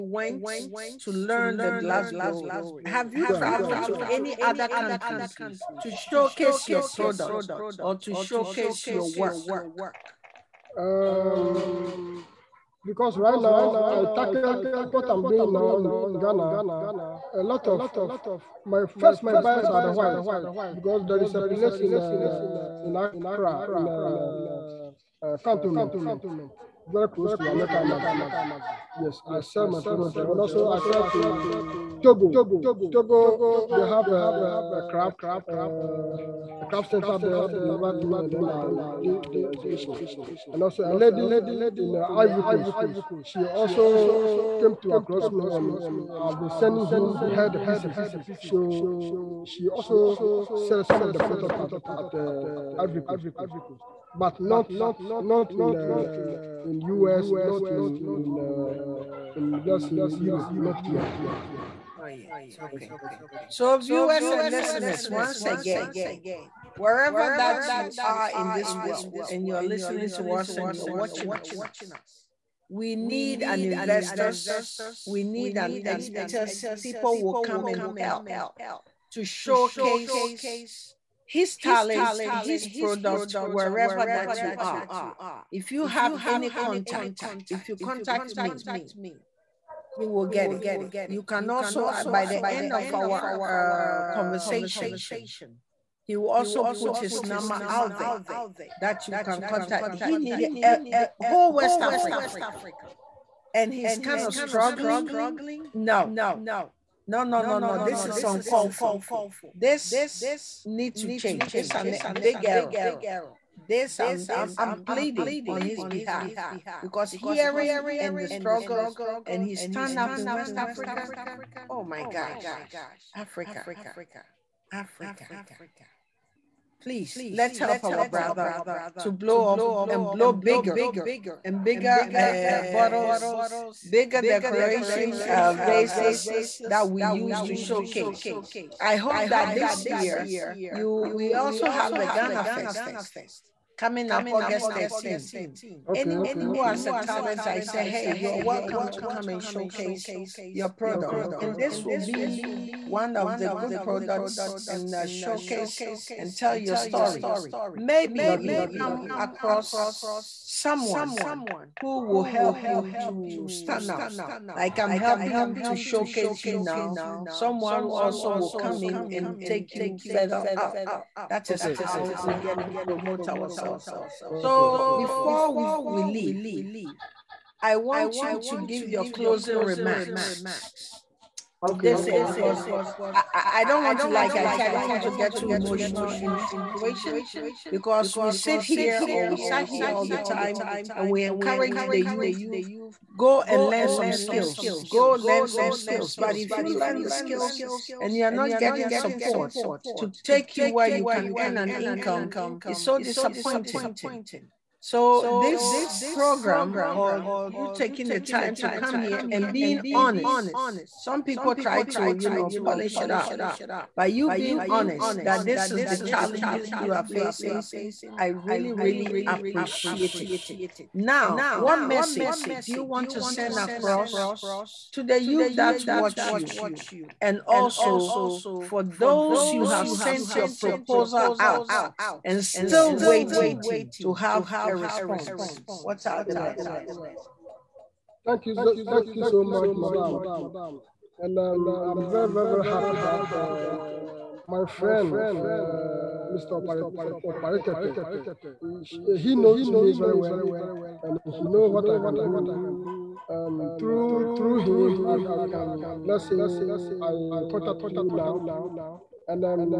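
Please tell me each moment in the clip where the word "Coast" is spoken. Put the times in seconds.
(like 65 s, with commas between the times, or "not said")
42 s, 53 s.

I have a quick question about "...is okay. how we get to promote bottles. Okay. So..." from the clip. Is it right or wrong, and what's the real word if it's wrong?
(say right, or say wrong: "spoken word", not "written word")
wrong: "ourselves", not "bottles".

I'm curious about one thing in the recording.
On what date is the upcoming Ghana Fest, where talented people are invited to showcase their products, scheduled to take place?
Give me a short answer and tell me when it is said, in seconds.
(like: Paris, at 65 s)
August 13, at 144 s.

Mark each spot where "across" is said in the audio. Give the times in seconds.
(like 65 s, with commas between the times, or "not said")
44 s, 159 s, 223 s.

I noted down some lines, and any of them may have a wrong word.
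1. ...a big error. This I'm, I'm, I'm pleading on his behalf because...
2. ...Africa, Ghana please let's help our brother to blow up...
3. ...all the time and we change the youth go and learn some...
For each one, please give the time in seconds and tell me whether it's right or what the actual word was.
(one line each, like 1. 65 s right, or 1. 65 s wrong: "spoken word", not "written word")
1. 111 s right
2. 123 s wrong: "Africa", not "Ghana"
3. 189 s wrong: "encourage", not "change".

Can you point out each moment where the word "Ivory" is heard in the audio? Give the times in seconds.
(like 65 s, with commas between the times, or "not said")
42 s, 52 s.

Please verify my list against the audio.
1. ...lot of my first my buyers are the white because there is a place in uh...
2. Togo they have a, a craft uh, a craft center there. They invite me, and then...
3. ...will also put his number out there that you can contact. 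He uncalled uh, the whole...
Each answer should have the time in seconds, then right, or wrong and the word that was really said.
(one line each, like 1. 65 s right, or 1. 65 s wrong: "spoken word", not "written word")
1. 17 s right
2. 32 s right
3. 96 s wrong: "needed", not "uncalled".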